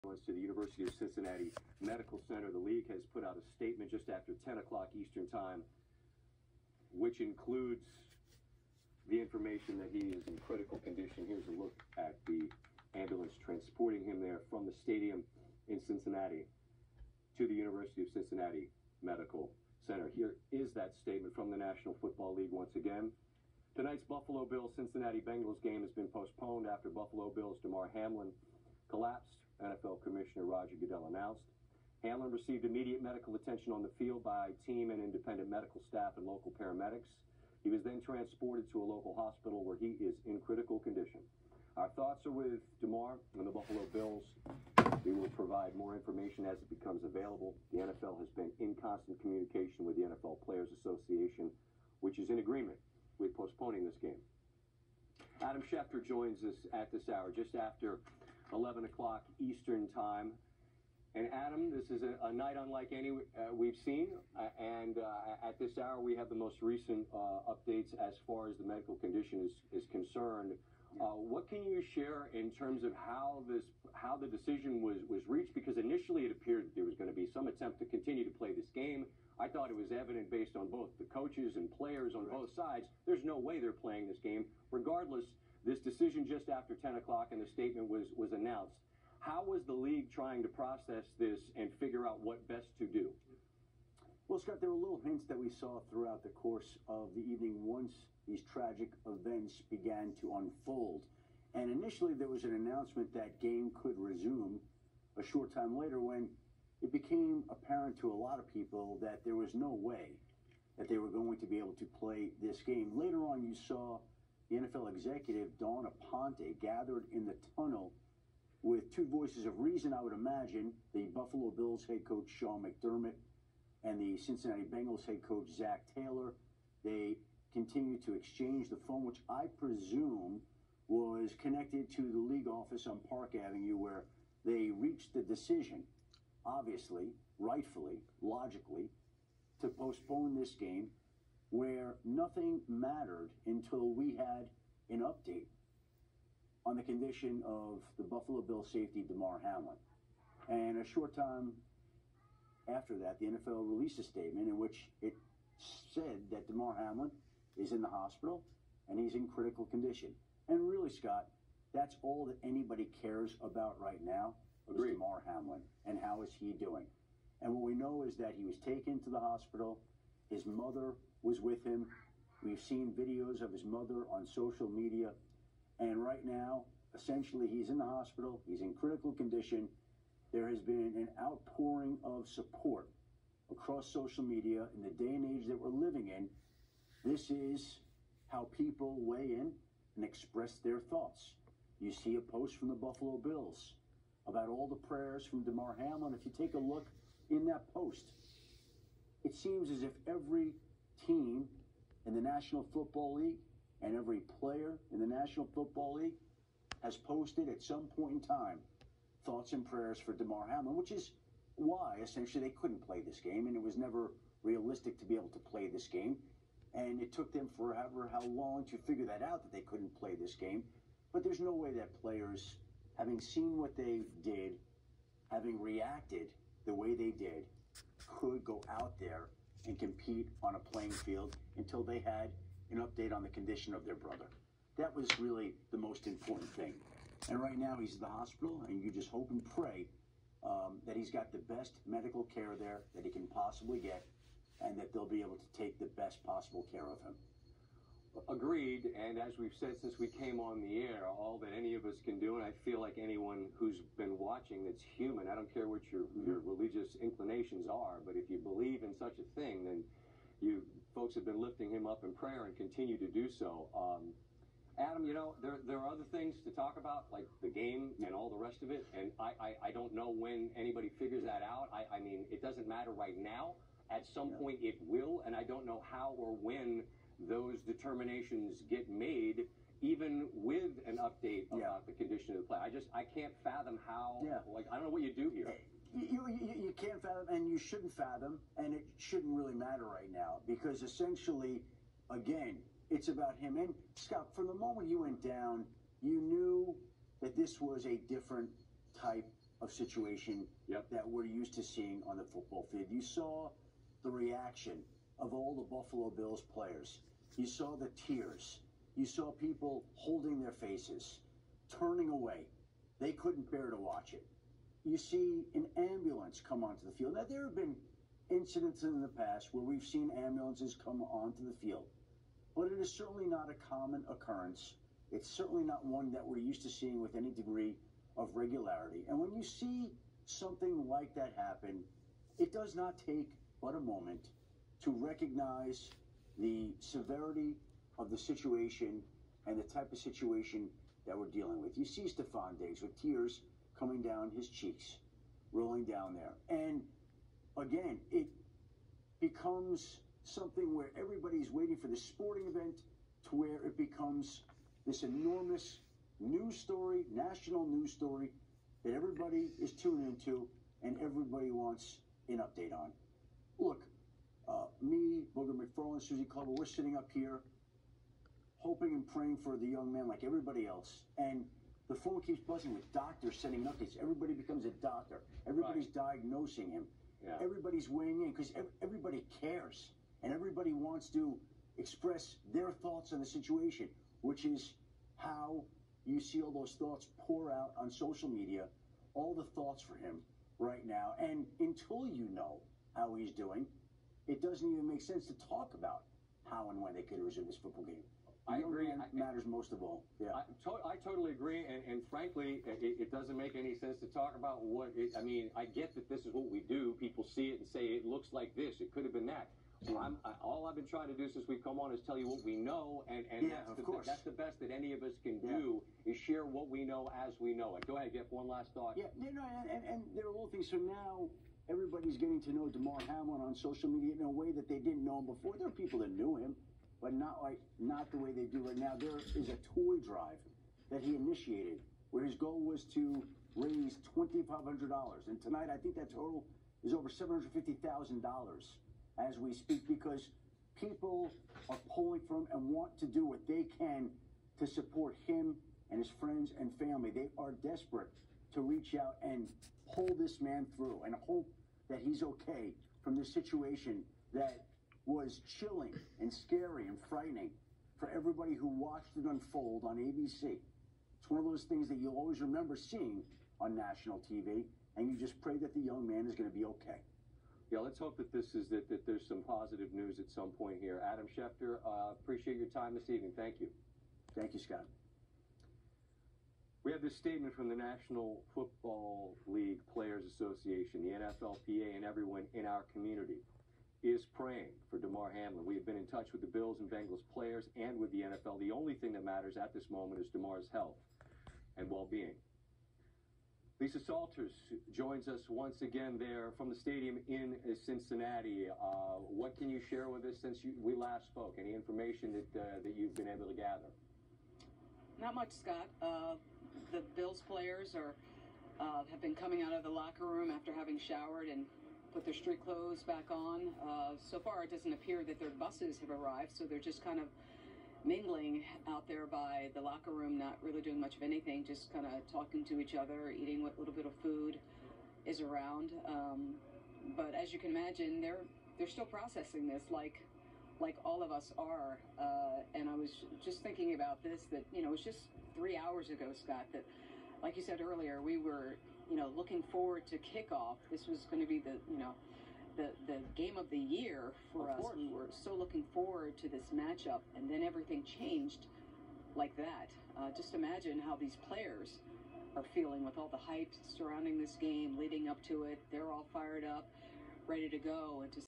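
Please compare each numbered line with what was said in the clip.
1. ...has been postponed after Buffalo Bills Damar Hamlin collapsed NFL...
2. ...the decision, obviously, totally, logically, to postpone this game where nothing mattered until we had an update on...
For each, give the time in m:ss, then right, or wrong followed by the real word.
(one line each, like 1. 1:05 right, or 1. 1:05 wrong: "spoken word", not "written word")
1. 0:25 right
2. 2:15 wrong: "rightfully", not "totally".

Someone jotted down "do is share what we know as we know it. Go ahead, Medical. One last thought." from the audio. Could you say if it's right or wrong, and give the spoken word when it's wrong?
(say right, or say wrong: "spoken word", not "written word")
wrong: "Jeff", not "Medical".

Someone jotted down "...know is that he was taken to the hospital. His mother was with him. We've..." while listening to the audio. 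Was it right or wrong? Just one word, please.
right.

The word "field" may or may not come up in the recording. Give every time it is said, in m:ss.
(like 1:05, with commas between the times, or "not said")
0:34, 3:50, 5:02, 5:16, 5:21.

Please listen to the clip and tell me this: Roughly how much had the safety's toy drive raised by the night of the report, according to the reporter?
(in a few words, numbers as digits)
Over $750,000.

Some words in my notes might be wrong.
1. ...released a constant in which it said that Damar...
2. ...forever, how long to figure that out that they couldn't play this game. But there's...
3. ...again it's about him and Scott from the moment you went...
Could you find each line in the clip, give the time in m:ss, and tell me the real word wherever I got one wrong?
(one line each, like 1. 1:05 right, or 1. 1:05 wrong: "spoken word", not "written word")
1. 2:33 wrong: "statement", not "constant"
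2. 3:37 right
3. 4:52 right.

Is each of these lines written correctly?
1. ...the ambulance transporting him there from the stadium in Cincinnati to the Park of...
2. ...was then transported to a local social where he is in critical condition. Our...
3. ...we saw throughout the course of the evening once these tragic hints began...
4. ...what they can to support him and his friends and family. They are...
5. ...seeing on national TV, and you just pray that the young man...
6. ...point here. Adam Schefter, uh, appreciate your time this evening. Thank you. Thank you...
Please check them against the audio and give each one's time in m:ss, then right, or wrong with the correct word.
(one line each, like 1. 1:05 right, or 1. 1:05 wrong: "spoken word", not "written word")
1. 0:12 wrong: "University", not "Park"
2. 0:37 wrong: "hospital", not "social"
3. 1:35 wrong: "events", not "hints"
4. 7:23 right
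5. 7:42 right
6. 7:50 right.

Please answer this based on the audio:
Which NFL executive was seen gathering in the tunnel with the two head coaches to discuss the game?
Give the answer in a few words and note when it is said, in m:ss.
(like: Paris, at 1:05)
Dawn Aponte, at 1:55.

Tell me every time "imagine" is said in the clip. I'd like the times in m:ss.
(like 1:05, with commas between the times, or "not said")
2:00, 8:47, 9:10.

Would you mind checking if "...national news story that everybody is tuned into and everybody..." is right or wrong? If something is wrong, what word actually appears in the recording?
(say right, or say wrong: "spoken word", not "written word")
right.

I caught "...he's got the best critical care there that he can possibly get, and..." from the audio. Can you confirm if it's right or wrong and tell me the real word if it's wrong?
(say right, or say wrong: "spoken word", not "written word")
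wrong: "medical", not "critical".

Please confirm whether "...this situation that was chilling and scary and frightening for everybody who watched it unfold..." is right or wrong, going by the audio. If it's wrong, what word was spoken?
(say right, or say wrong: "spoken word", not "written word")
right.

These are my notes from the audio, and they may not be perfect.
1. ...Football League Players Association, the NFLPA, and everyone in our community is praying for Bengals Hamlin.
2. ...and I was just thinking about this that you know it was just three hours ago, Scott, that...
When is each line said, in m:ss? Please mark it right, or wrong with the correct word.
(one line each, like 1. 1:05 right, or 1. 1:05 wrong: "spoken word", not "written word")
1. 7:58 wrong: "Damar", not "Bengals"
2. 8:52 right.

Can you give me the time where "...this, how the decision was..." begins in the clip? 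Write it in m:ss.
1:13.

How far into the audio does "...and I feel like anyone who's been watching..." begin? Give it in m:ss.
4:12.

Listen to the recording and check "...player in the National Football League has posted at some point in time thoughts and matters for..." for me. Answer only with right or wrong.
wrong.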